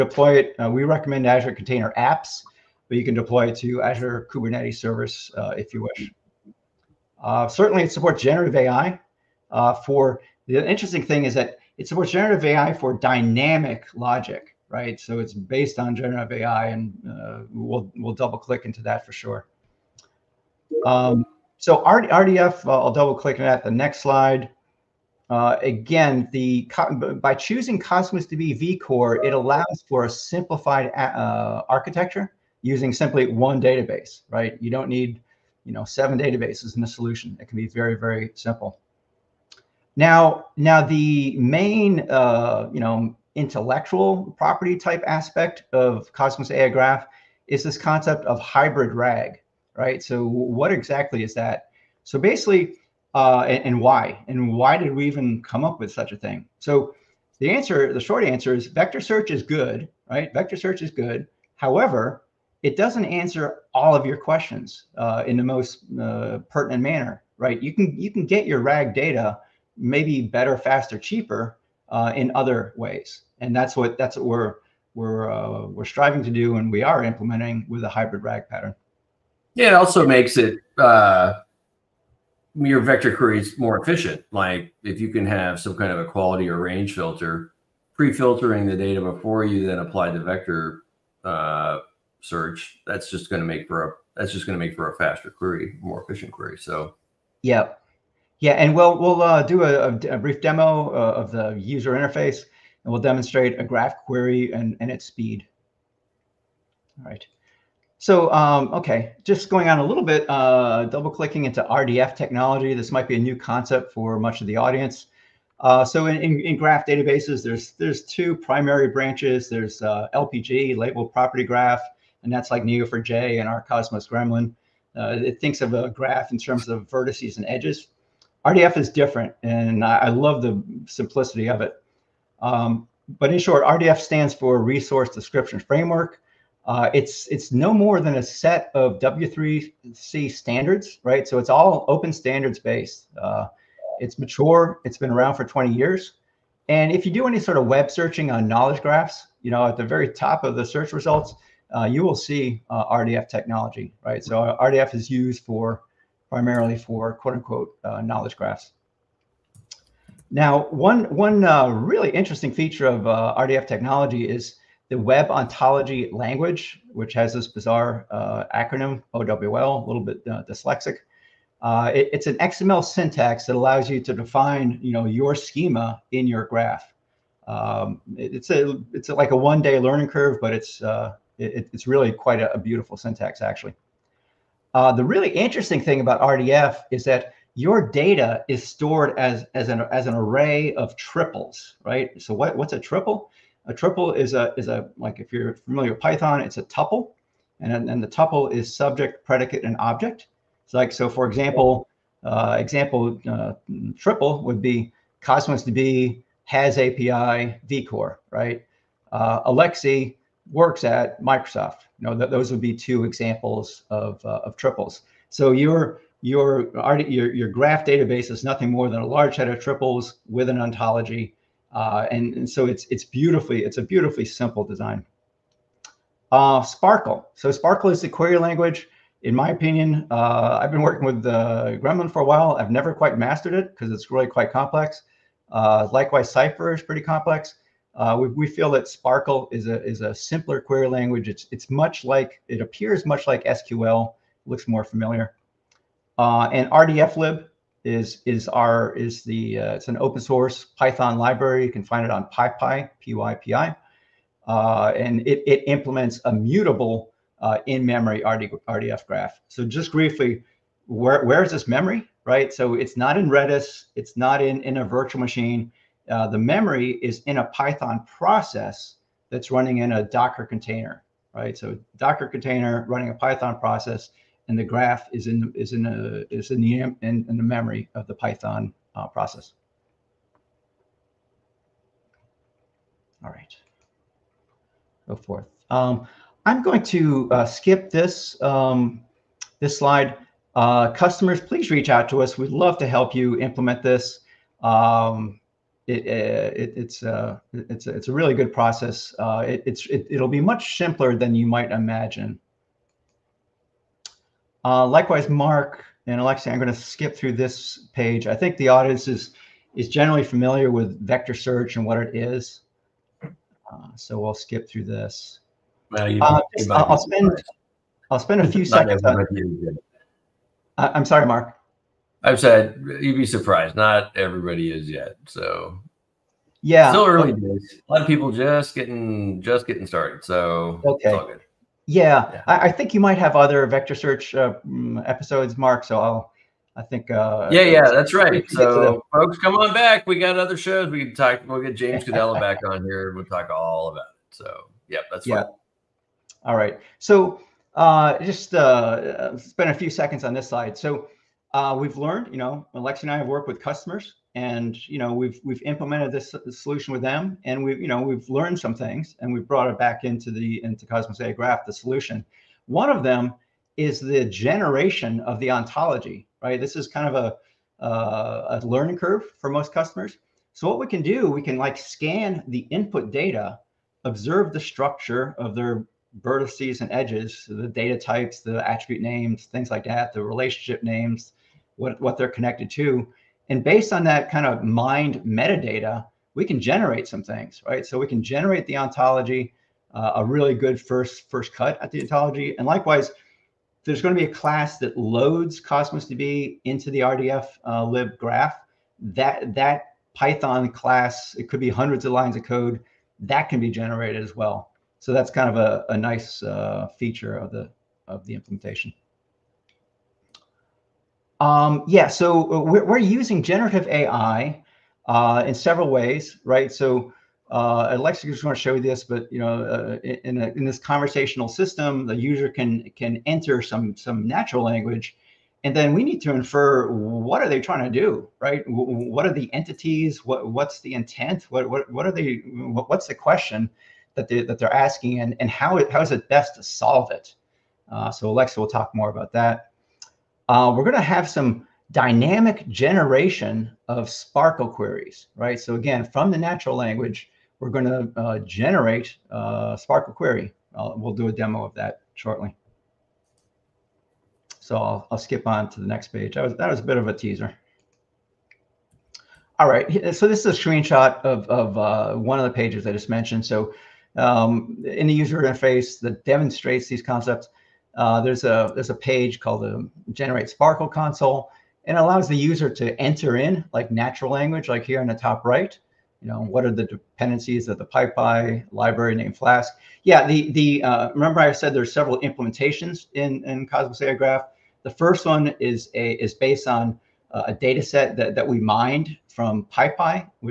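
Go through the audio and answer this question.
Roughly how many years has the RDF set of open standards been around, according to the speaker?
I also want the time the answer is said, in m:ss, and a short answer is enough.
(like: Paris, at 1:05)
20 years, at 2:25.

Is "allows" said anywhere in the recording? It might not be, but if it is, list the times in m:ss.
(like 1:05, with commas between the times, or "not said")
0:29, 2:53, 7:51.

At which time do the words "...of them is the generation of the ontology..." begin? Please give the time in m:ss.
6:02.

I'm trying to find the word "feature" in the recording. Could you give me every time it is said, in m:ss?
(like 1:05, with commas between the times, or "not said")
2:42, 6:46.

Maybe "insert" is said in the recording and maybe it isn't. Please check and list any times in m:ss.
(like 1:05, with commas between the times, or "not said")
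not said.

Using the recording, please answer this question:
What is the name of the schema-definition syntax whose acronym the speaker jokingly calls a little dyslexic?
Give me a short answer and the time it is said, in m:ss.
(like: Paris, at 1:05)
Web Ontology Language, at 2:44.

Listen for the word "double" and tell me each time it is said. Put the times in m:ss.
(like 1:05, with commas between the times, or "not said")
0:18, 0:22, 1:50.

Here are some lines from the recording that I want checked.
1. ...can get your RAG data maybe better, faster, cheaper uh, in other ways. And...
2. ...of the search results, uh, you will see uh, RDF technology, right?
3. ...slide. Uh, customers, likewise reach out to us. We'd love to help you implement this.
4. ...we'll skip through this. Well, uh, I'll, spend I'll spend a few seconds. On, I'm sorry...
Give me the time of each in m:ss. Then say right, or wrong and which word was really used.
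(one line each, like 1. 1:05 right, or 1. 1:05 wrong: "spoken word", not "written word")
1. 1:08 right
2. 2:30 right
3. 4:49 wrong: "please", not "likewise"
4. 5:14 right.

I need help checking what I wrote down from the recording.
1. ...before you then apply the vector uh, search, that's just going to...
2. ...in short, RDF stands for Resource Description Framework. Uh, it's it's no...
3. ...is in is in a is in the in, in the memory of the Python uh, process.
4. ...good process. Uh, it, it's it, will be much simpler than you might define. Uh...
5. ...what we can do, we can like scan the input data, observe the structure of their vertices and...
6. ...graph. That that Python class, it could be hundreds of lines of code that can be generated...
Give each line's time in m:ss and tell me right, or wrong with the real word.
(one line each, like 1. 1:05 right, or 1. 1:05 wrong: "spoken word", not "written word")
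1. 1:29 right
2. 2:13 right
3. 4:35 right
4. 4:58 wrong: "imagine", not "define"
5. 6:10 right
6. 6:38 right.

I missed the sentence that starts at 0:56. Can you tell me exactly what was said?
So the answer, the short answer is vector search is good, right?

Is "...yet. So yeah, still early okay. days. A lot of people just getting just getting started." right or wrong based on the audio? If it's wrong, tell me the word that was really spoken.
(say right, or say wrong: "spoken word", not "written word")
right.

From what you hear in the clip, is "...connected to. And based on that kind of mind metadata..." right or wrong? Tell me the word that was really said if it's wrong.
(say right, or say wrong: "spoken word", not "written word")
right.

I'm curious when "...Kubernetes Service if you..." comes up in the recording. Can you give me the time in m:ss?
0:04.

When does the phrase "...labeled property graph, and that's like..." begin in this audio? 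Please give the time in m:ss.
2:00.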